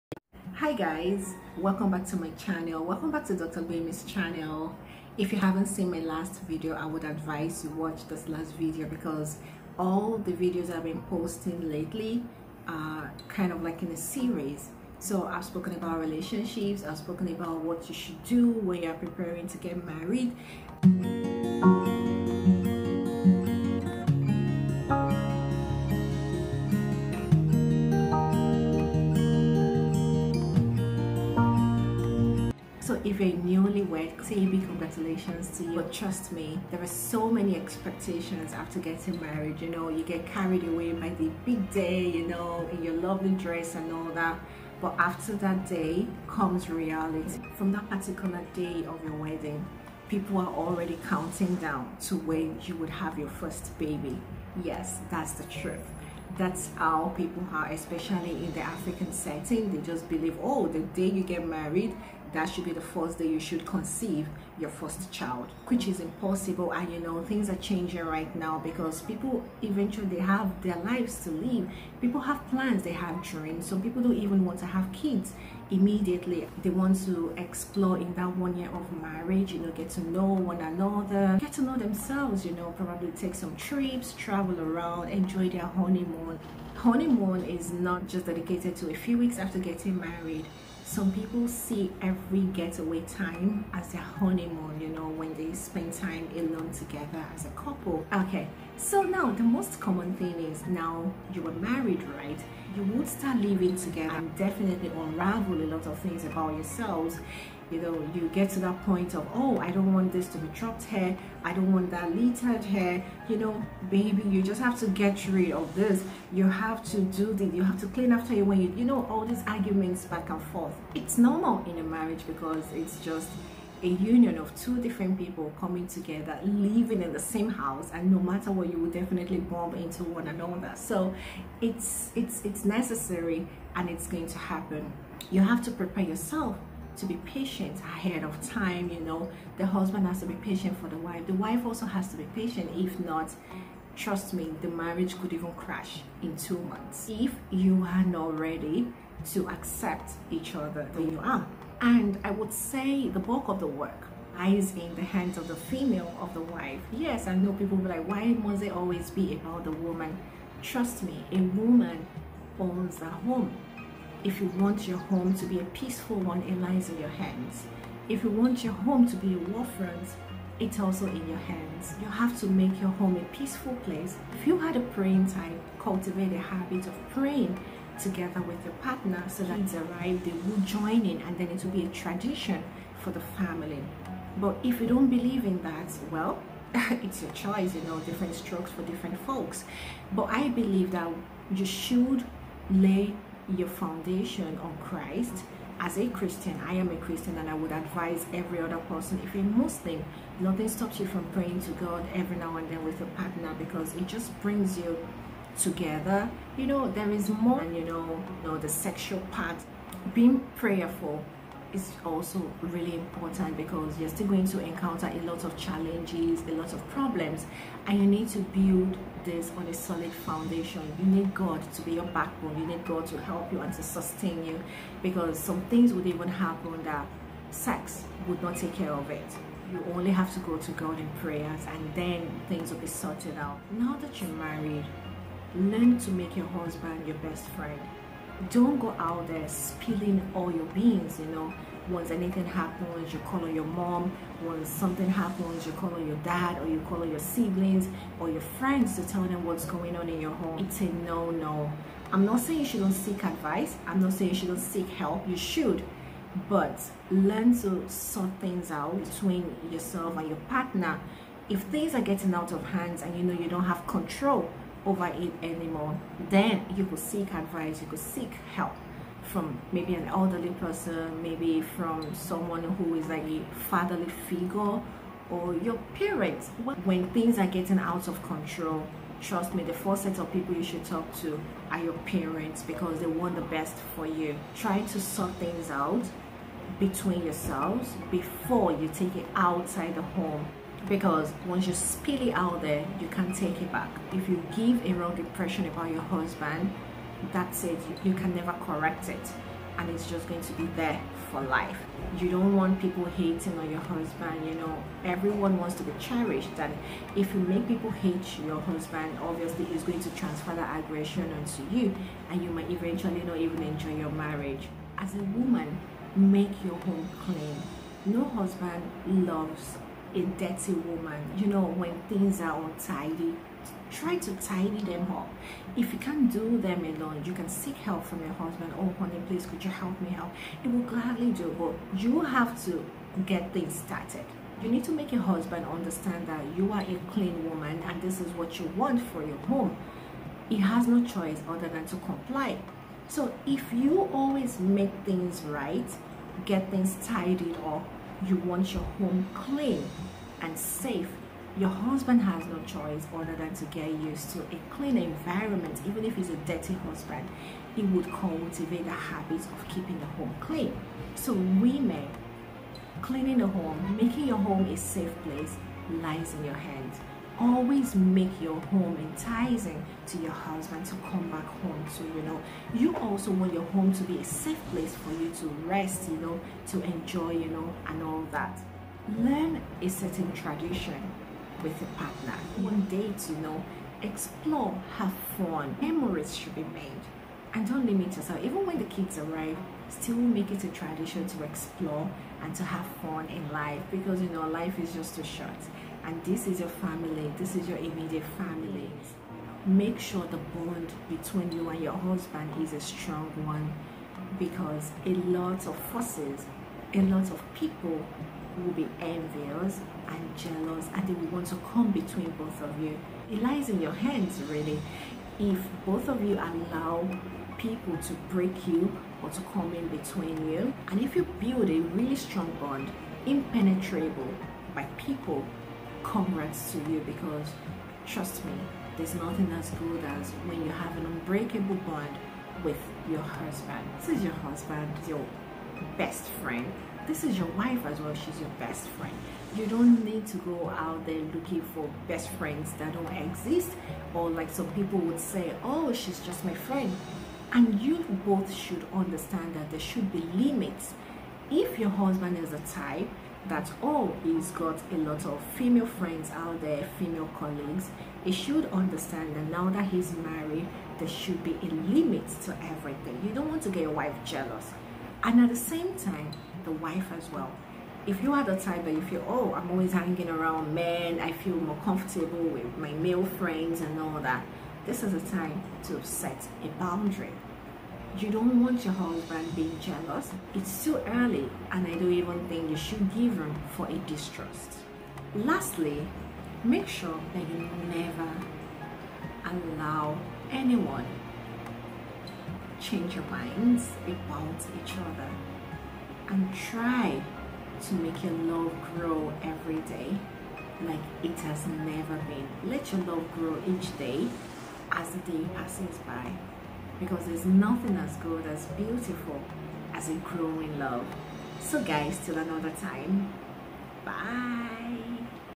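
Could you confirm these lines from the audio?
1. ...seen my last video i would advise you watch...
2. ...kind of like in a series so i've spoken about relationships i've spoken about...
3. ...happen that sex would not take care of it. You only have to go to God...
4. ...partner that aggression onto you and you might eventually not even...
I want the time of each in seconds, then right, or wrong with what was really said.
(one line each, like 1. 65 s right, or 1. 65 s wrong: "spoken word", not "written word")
1. 5 s right
2. 13 s right
3. 226 s right
4. 310 s wrong: "transfer", not "partner".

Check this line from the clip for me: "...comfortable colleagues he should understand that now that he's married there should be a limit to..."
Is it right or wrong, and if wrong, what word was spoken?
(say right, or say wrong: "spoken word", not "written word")
wrong: "female", not "comfortable".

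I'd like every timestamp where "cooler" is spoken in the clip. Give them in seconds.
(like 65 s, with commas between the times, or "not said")
not said.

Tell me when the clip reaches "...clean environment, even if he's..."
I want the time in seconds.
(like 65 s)
354 s.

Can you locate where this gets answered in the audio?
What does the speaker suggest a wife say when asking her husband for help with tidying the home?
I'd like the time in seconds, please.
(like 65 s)
328 s.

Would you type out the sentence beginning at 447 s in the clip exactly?
And you both should understand that there should be limits.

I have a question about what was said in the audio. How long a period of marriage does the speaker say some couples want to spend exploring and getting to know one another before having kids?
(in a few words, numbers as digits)
1 year.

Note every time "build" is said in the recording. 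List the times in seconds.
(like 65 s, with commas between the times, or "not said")
218 s, 421 s.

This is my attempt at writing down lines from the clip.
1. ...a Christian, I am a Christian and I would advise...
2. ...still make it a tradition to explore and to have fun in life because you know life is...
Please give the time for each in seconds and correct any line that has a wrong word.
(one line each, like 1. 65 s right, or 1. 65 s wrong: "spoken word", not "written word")
1. 195 s right
2. 389 s right.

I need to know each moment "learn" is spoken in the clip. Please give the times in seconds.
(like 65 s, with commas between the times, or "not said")
235 s, 257 s, 379 s.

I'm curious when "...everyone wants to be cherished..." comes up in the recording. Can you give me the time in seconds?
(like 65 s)
305 s.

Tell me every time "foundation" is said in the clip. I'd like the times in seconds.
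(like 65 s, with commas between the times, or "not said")
193 s, 220 s.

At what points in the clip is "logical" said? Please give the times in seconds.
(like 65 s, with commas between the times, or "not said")
not said.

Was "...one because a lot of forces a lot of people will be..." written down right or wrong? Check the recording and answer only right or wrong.
right.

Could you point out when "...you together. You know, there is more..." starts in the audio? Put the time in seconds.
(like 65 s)
204 s.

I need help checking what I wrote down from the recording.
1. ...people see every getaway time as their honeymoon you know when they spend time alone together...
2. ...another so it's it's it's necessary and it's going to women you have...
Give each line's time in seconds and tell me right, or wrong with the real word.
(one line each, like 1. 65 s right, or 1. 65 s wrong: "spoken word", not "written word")
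1. 91 s right
2. 130 s wrong: "happen", not "women".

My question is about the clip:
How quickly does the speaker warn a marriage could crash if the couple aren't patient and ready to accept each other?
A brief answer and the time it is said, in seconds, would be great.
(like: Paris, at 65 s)
2 months, at 146 s.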